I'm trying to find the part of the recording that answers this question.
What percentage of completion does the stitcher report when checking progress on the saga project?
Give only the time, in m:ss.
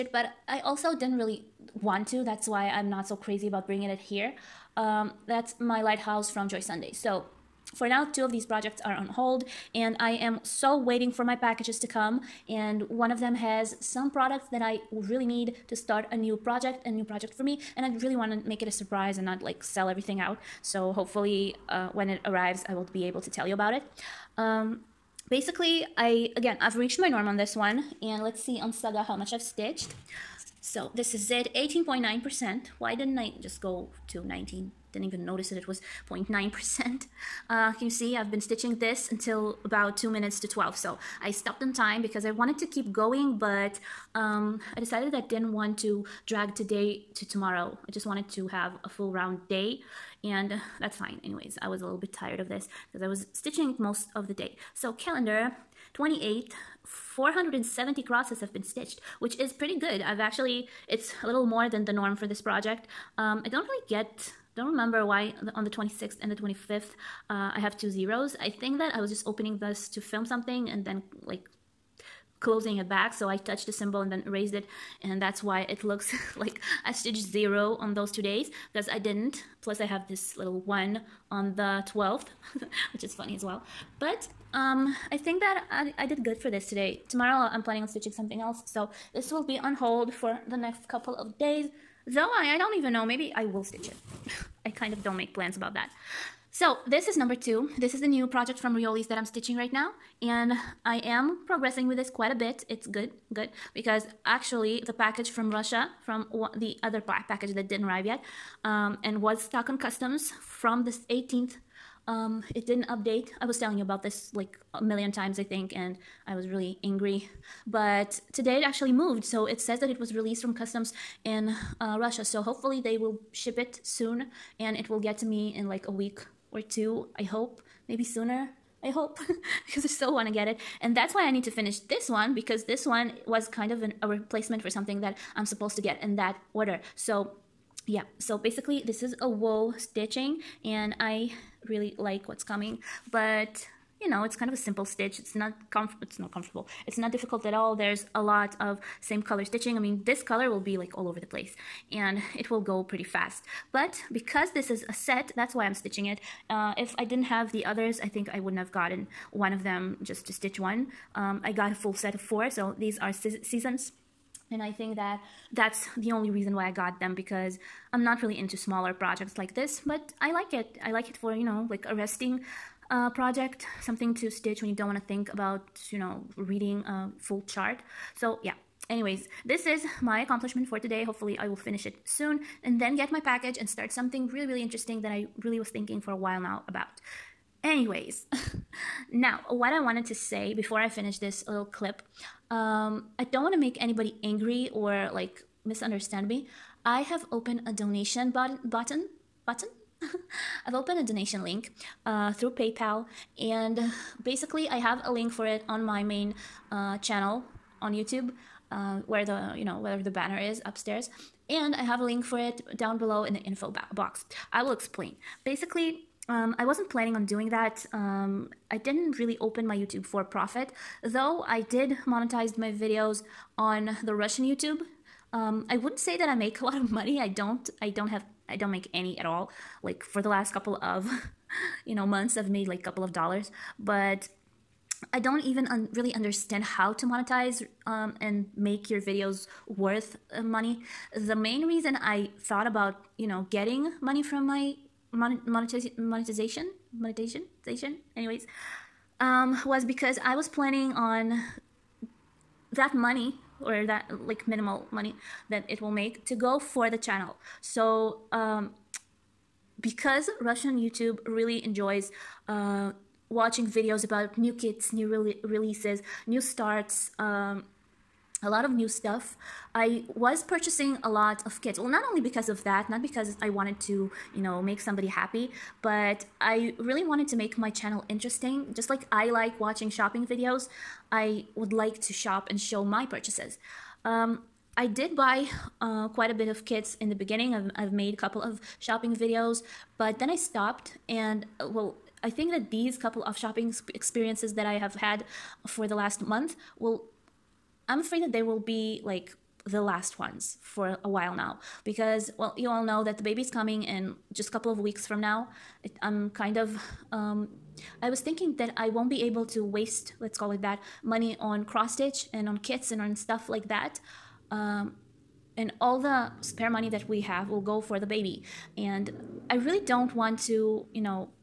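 0:31.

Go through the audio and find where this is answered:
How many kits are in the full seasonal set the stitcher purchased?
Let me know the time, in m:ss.
2:42.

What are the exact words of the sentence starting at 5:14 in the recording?
Um, and all the spare money that we have will go for the baby.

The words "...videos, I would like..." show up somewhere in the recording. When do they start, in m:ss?
4:40.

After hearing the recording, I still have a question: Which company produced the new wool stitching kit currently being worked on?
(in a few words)
Riolis.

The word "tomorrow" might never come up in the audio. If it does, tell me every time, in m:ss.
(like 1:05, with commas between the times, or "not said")
0:47, 1:27.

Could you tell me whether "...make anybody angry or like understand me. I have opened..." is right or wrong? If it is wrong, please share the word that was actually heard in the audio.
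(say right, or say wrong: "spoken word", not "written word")
wrong: "misunderstand", not "understand".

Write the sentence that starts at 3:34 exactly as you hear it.
I will explain basically, um, I wasn't planning on doing that.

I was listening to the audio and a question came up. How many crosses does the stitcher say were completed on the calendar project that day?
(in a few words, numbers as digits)
470.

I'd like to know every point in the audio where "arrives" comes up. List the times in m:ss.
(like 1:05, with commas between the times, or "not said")
0:22, 1:47.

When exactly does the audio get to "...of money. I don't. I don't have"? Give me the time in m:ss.
3:46.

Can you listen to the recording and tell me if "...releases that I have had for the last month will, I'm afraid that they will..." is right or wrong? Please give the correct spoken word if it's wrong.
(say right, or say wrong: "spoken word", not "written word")
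wrong: "experiences", not "releases".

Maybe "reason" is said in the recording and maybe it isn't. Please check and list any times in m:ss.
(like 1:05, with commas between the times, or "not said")
2:46, 4:01.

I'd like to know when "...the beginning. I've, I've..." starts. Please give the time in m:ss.
4:47.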